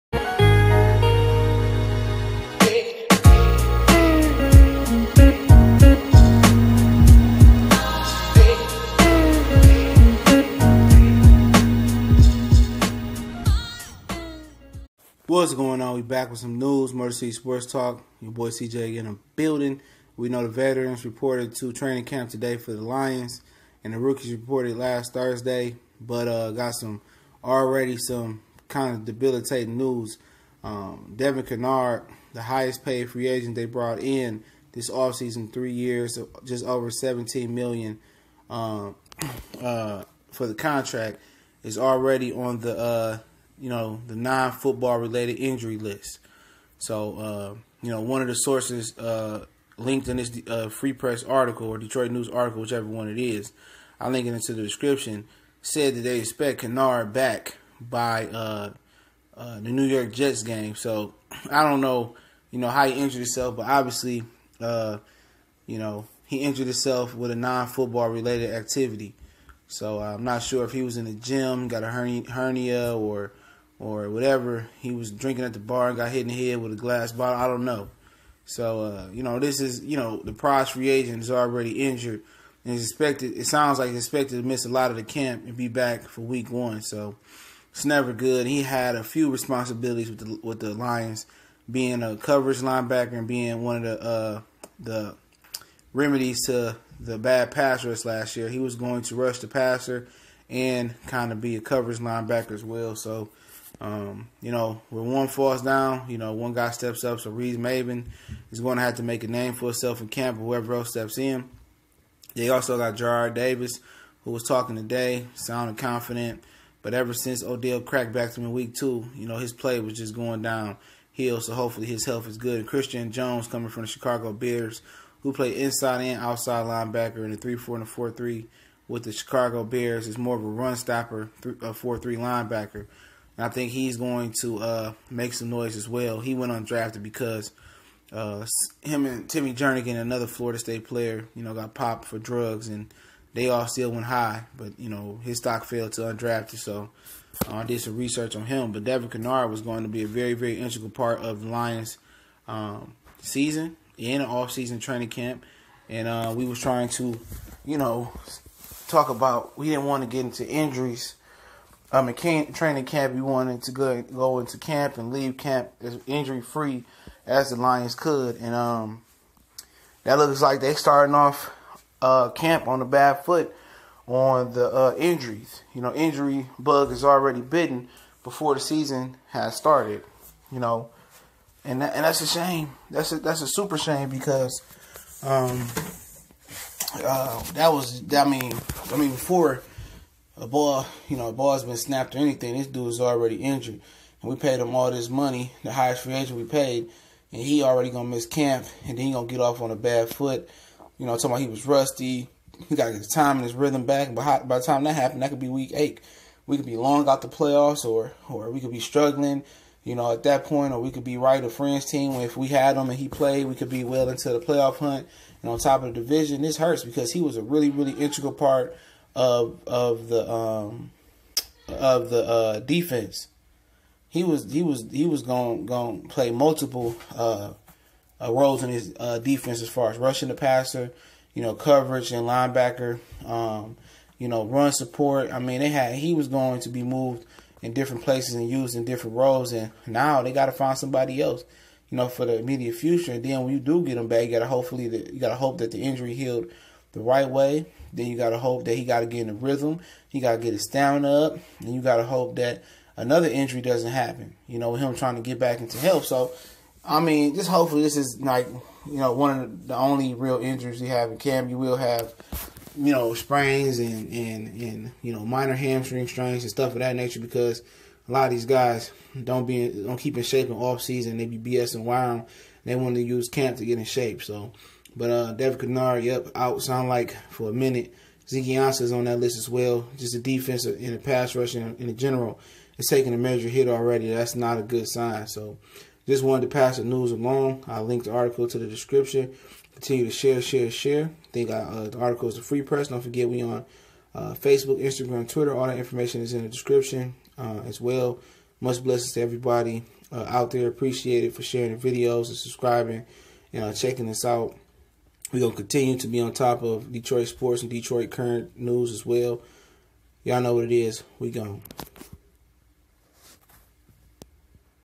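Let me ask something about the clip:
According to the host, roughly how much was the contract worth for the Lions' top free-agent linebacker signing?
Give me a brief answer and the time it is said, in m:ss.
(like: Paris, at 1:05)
17 million, at 0:36.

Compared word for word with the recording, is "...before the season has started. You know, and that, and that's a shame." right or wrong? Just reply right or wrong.
right.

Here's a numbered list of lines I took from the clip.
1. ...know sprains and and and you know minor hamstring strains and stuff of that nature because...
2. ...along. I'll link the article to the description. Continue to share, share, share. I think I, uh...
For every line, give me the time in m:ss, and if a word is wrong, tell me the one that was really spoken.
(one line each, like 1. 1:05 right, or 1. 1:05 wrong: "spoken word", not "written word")
1. 4:22 right
2. 4:47 right.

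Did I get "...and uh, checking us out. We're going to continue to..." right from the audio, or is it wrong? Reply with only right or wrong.
right.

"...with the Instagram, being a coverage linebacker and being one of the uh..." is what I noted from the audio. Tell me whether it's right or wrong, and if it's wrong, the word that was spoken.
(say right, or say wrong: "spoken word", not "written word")
wrong: "Lions", not "Instagram".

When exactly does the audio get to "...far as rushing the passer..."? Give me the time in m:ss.
3:49.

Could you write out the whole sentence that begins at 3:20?
You know, talking about he was rusty.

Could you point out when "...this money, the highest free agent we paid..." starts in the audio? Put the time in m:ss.
3:14.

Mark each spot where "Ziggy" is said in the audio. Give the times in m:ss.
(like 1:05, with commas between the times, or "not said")
4:38.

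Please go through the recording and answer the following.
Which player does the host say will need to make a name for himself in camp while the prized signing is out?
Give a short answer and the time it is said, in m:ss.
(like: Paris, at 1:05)
Reeves-Maybin, at 1:47.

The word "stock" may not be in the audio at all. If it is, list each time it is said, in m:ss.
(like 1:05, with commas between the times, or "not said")
2:25.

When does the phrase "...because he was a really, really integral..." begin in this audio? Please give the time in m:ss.
3:36.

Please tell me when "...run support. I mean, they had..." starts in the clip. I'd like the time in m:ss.
3:54.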